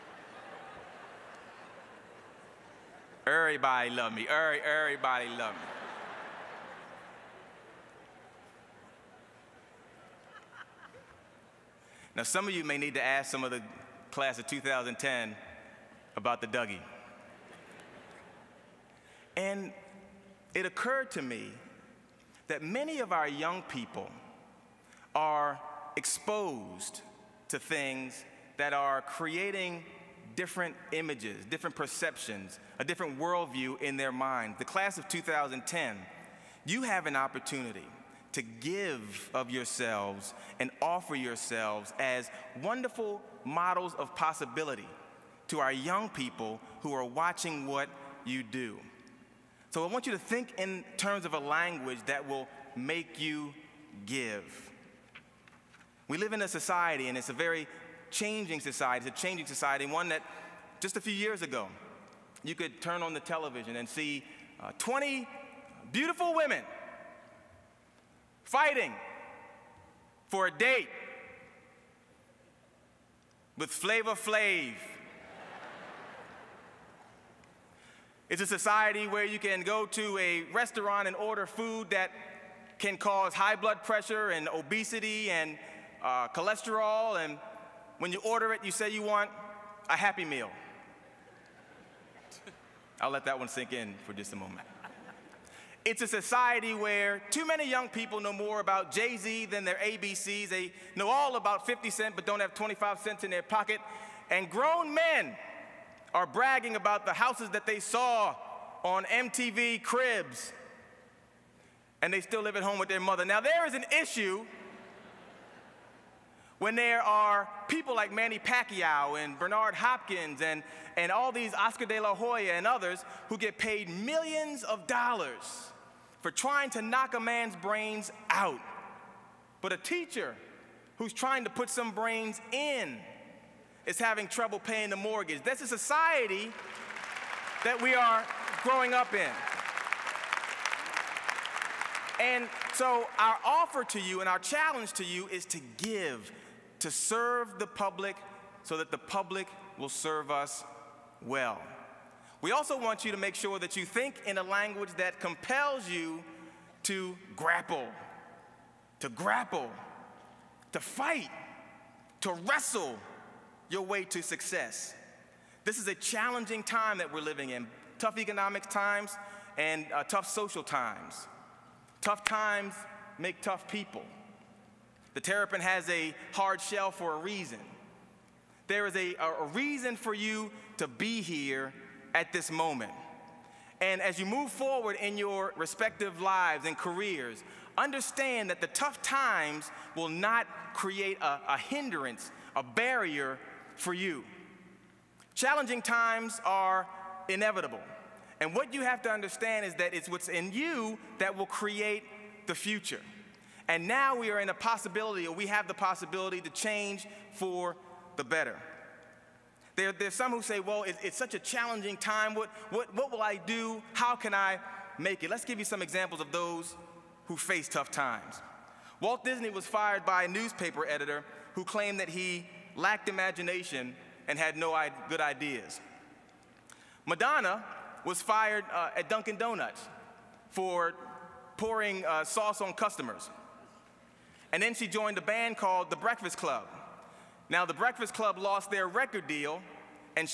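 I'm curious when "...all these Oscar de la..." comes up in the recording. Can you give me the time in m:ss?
2:01.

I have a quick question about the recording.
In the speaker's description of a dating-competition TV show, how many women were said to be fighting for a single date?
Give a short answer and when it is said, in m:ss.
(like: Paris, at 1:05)
20, at 1:04.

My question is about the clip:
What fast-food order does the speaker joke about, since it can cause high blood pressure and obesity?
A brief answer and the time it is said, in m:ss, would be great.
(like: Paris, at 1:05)
Happy Meal, at 1:29.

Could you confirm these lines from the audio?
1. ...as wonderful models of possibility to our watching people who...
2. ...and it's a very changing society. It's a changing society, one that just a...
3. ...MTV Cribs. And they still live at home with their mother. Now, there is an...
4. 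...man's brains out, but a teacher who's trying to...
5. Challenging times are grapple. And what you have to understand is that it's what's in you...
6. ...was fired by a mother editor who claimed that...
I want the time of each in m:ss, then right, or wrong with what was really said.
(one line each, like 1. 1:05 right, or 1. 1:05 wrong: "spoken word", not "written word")
1. 0:41 wrong: "young", not "watching"
2. 0:57 right
3. 1:49 right
4. 2:07 right
5. 3:15 wrong: "inevitable", not "grapple"
6. 3:39 wrong: "newspaper", not "mother".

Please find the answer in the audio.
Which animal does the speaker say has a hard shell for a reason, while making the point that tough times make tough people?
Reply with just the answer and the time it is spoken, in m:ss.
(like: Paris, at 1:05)
Terrapin, at 2:55.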